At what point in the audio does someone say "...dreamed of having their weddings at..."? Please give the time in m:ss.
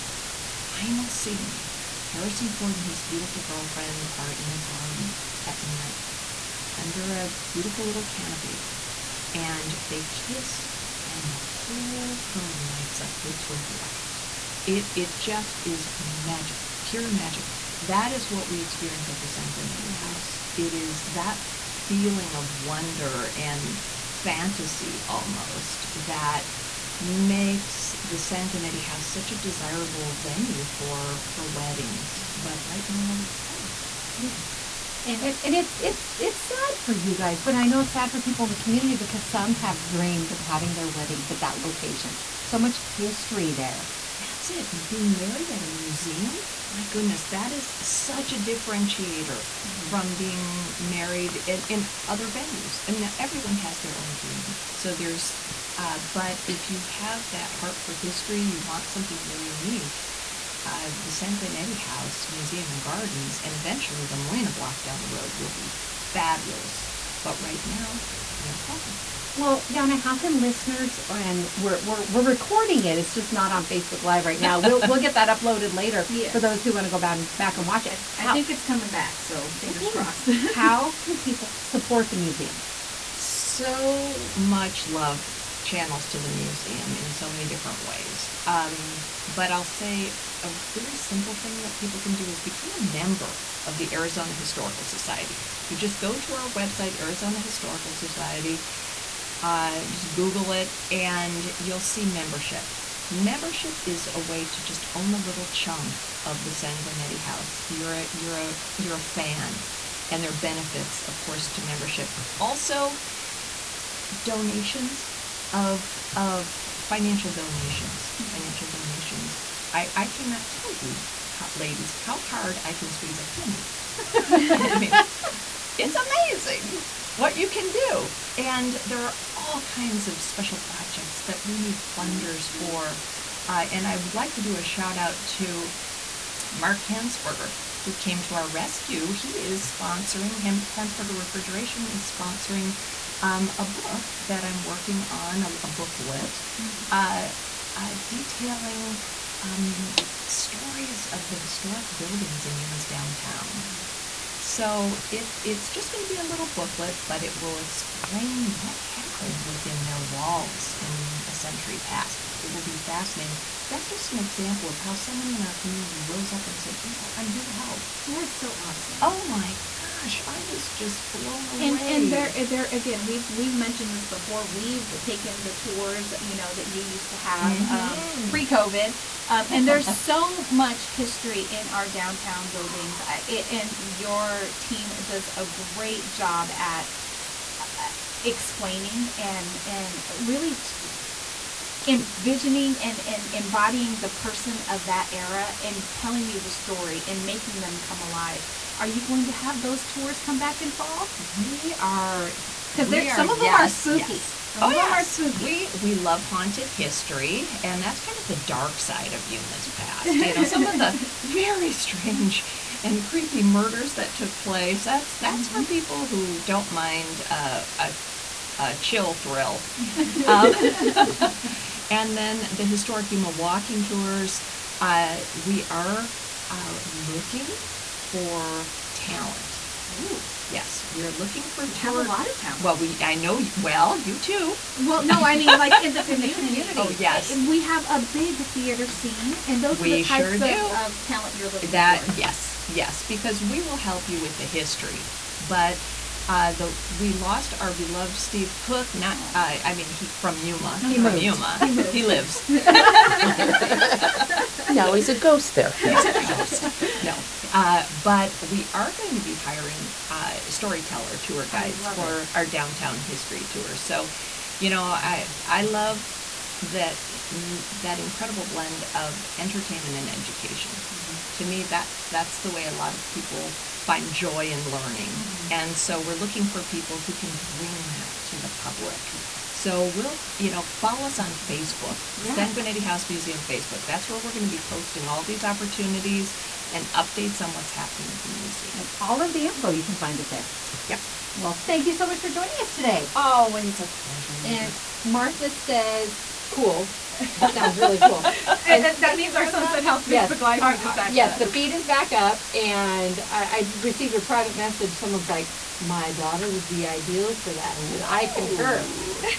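0:39.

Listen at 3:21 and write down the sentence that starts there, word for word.
We are because some of yes, them are spooky.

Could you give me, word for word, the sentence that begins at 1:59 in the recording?
I, I cannot tell you, how, ladies, how hard I can squeeze a penny.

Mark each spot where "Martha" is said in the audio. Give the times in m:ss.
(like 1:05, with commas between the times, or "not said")
4:55.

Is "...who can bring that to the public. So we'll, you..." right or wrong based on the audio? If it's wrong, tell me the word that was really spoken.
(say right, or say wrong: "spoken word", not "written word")
right.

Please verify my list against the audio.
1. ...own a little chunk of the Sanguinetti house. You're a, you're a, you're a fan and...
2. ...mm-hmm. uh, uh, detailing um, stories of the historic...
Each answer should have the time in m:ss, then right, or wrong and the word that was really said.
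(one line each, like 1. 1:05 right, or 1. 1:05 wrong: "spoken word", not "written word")
1. 1:44 right
2. 2:26 right.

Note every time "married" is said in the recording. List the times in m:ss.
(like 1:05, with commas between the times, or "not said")
0:45, 0:50.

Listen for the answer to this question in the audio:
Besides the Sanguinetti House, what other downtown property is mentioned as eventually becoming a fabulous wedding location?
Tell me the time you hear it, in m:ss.
1:04.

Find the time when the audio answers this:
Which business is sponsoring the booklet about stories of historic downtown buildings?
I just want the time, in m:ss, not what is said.
2:20.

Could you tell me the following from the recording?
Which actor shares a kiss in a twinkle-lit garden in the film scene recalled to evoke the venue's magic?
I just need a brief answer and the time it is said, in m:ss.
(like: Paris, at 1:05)
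Harrison Ford, at 0:02.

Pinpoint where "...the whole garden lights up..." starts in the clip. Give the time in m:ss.
0:11.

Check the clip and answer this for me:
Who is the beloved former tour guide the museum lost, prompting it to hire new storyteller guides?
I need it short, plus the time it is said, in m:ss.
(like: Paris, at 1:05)
Steve Cook, at 4:08.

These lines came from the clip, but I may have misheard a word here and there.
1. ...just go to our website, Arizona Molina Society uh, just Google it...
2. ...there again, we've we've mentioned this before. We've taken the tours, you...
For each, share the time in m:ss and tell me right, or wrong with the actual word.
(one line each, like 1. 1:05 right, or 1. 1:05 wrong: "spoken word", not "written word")
1. 1:35 wrong: "Historical", not "Molina"
2. 2:52 right.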